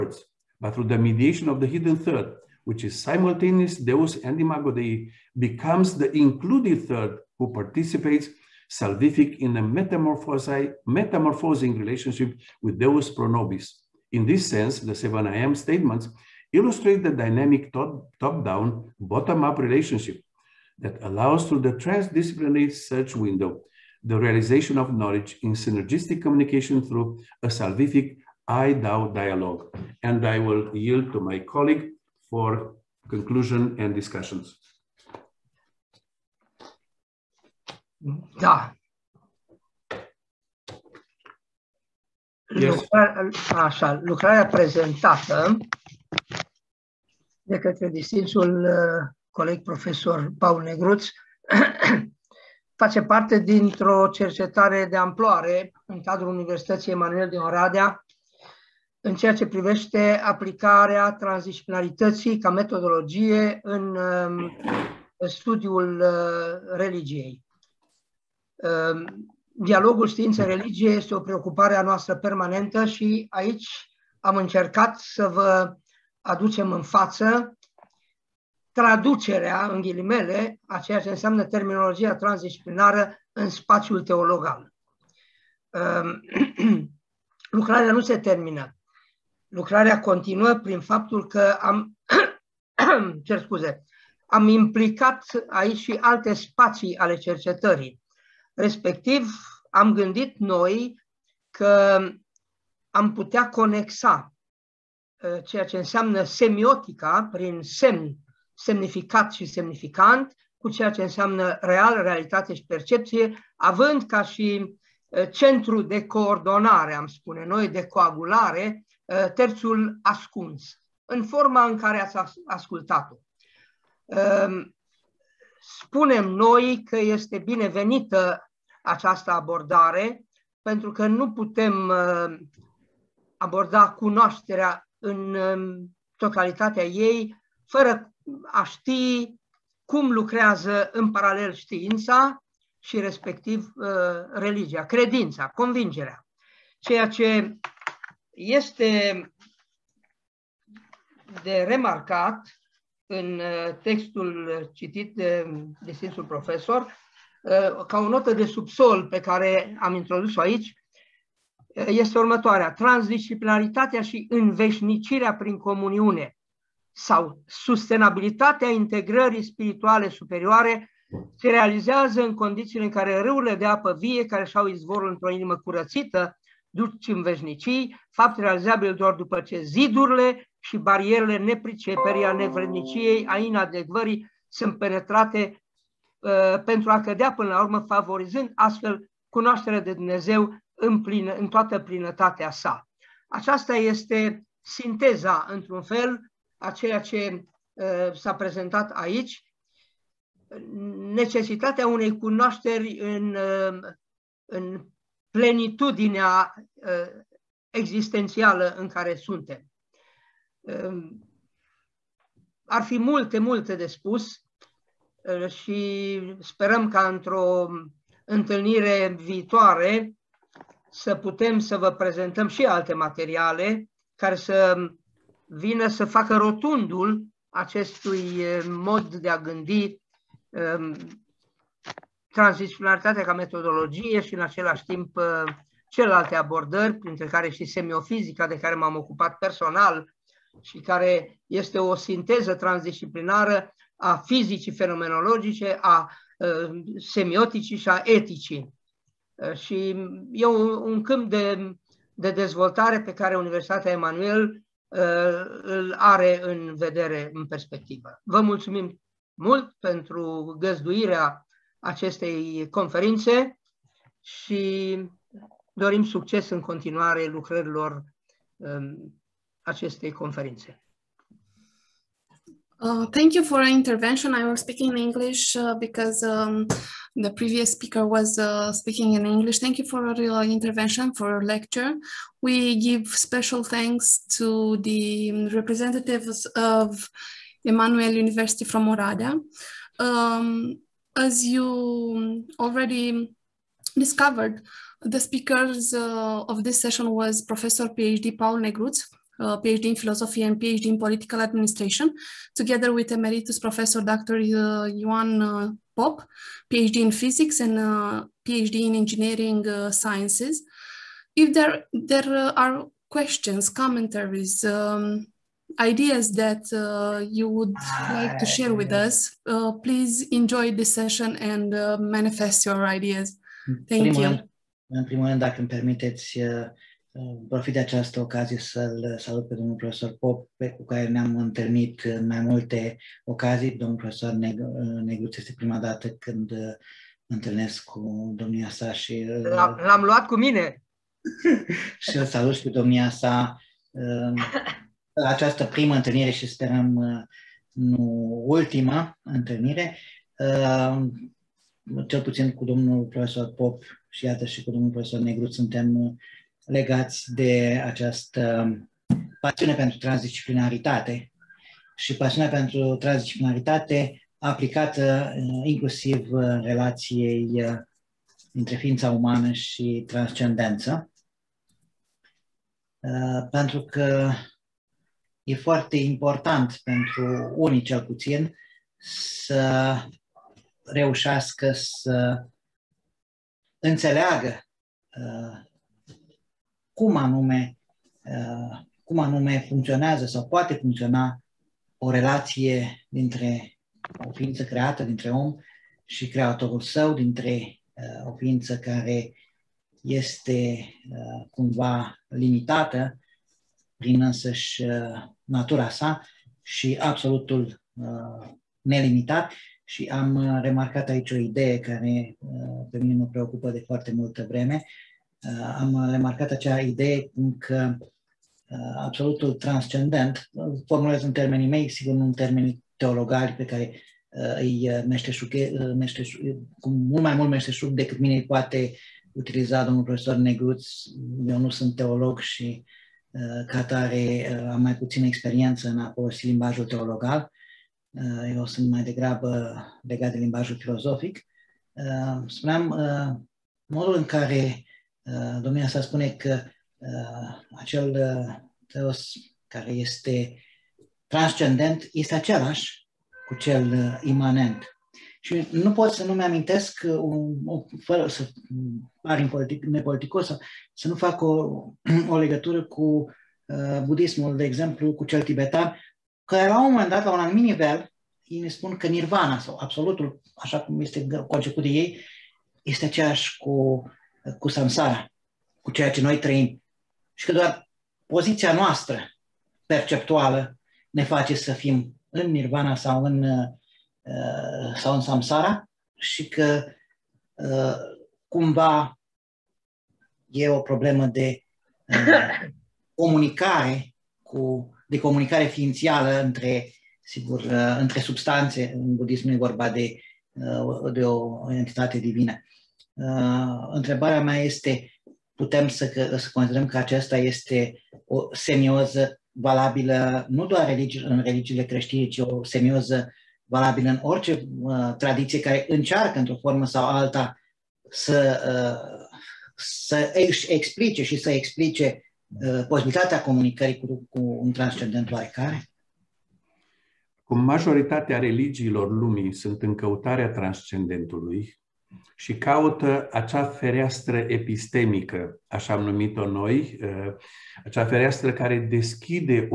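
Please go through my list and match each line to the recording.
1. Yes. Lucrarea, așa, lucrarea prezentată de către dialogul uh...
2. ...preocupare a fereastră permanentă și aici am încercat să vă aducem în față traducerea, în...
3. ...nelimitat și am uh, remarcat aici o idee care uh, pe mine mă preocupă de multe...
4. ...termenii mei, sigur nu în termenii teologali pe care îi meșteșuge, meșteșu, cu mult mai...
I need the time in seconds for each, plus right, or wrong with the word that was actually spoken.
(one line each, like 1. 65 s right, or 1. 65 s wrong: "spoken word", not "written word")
1. 42 s wrong: "distinsul", not "dialogul"
2. 71 s wrong: "noastră", not "fereastră"
3. 408 s wrong: "foarte", not "multe"
4. 421 s right.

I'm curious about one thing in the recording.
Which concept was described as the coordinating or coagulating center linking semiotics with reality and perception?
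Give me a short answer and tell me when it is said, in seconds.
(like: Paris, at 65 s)
hidden third, at 119 s.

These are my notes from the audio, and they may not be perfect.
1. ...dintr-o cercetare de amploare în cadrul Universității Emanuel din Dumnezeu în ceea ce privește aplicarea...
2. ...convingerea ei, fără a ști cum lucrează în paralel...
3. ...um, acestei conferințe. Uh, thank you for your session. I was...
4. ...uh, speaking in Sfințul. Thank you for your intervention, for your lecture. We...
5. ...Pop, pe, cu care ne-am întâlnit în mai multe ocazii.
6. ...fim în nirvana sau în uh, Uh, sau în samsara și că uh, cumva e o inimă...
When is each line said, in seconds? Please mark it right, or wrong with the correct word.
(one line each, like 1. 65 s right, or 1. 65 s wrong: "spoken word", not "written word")
1. 53 s wrong: "Oradea", not "Dumnezeu"
2. 136 s wrong: "totalitatea", not "convingerea"
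3. 268 s wrong: "intervention", not "session"
4. 278 s wrong: "English", not "Sfințul"
5. 330 s right
6. 481 s wrong: "problemă", not "inimă".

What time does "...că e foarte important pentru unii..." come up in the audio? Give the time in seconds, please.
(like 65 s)
373 s.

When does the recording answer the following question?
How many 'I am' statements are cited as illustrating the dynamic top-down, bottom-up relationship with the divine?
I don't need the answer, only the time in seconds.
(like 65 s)
14 s.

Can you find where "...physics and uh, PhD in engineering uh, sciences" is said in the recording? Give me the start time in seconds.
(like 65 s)
307 s.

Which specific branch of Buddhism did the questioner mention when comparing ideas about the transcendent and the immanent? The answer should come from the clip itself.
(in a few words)
Tibetan.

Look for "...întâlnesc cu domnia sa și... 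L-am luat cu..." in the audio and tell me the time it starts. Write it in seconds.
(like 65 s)
337 s.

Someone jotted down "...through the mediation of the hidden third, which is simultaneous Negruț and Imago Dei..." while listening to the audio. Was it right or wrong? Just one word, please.
wrong.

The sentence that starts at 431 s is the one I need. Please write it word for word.
Eu nu sunt teolog și uh, Uh, ca tare uh, am mai puțină experiență în a folosi limbajul teologal.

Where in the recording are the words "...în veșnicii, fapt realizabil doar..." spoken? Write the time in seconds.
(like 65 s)
177 s.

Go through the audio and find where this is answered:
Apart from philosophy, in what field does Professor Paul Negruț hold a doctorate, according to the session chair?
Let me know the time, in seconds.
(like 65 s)
300 s.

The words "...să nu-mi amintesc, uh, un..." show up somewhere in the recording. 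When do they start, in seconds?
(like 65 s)
456 s.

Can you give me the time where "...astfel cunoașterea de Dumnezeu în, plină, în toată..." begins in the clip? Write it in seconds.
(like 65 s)
188 s.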